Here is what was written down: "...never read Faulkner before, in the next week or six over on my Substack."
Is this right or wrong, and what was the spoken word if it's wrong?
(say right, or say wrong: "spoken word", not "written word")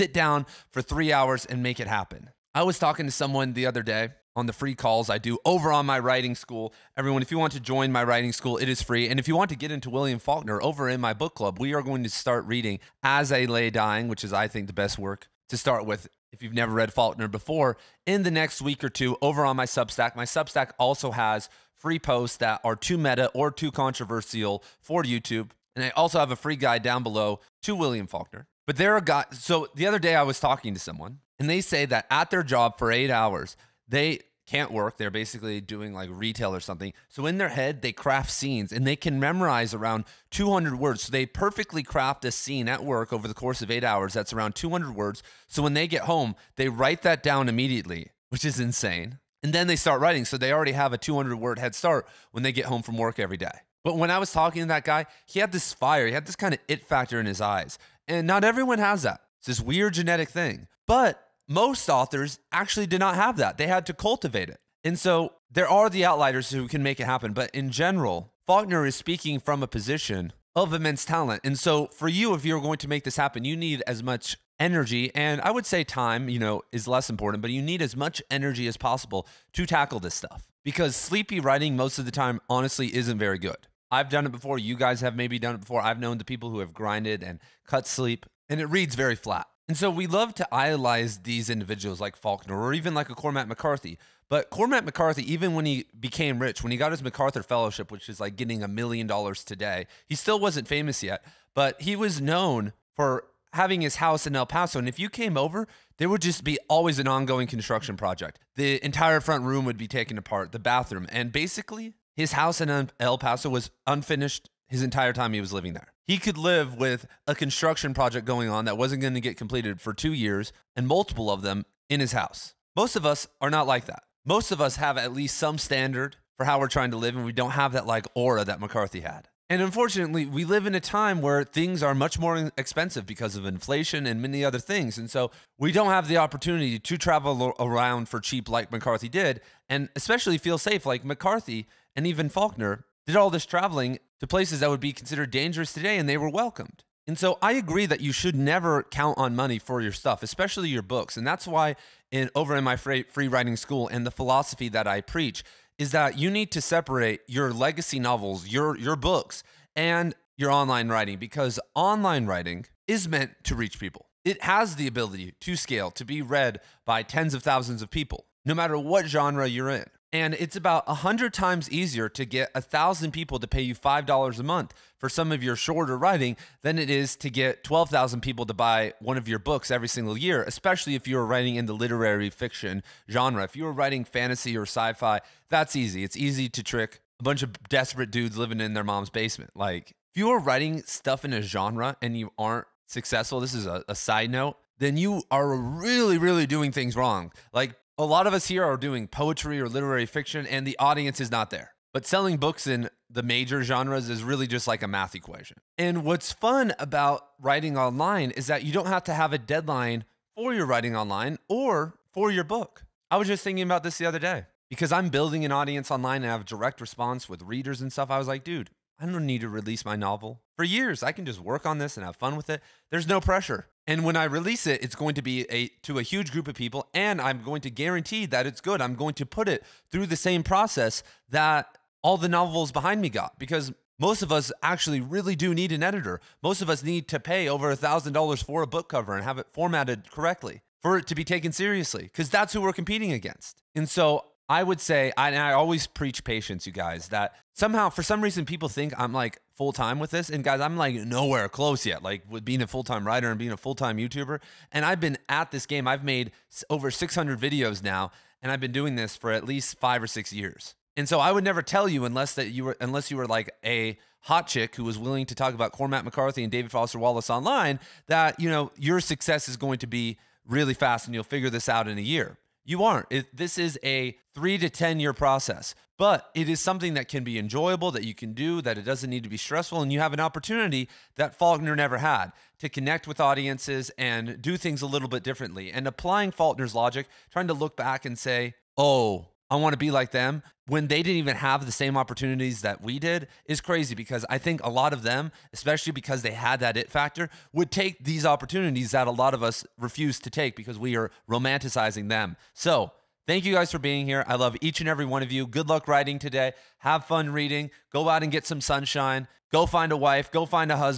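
wrong: "two", not "six".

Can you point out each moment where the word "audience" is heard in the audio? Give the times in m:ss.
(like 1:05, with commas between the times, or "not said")
3:20, 3:35, 4:43.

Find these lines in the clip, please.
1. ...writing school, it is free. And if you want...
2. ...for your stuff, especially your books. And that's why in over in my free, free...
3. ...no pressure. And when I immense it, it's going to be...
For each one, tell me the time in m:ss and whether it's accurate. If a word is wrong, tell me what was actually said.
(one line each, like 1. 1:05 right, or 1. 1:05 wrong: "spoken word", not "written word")
1. 0:08 right
2. 2:29 right
3. 3:43 wrong: "release", not "immense".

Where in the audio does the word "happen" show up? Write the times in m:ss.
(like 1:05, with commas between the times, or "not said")
0:01, 1:07, 1:13.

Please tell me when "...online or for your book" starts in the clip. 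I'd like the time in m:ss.
3:30.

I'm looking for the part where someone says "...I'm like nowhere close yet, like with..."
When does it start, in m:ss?
4:10.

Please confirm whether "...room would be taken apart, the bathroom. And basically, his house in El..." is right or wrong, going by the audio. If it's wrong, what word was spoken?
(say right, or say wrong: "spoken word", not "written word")
right.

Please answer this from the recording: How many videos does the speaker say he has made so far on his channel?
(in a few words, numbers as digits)
over 600.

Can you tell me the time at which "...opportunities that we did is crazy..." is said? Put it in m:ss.
4:51.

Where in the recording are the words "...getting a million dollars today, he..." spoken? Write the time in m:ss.
1:38.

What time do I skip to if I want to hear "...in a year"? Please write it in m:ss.
4:31.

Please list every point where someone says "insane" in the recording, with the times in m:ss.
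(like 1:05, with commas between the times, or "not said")
0:48.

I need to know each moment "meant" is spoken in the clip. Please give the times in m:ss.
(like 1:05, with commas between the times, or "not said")
2:43.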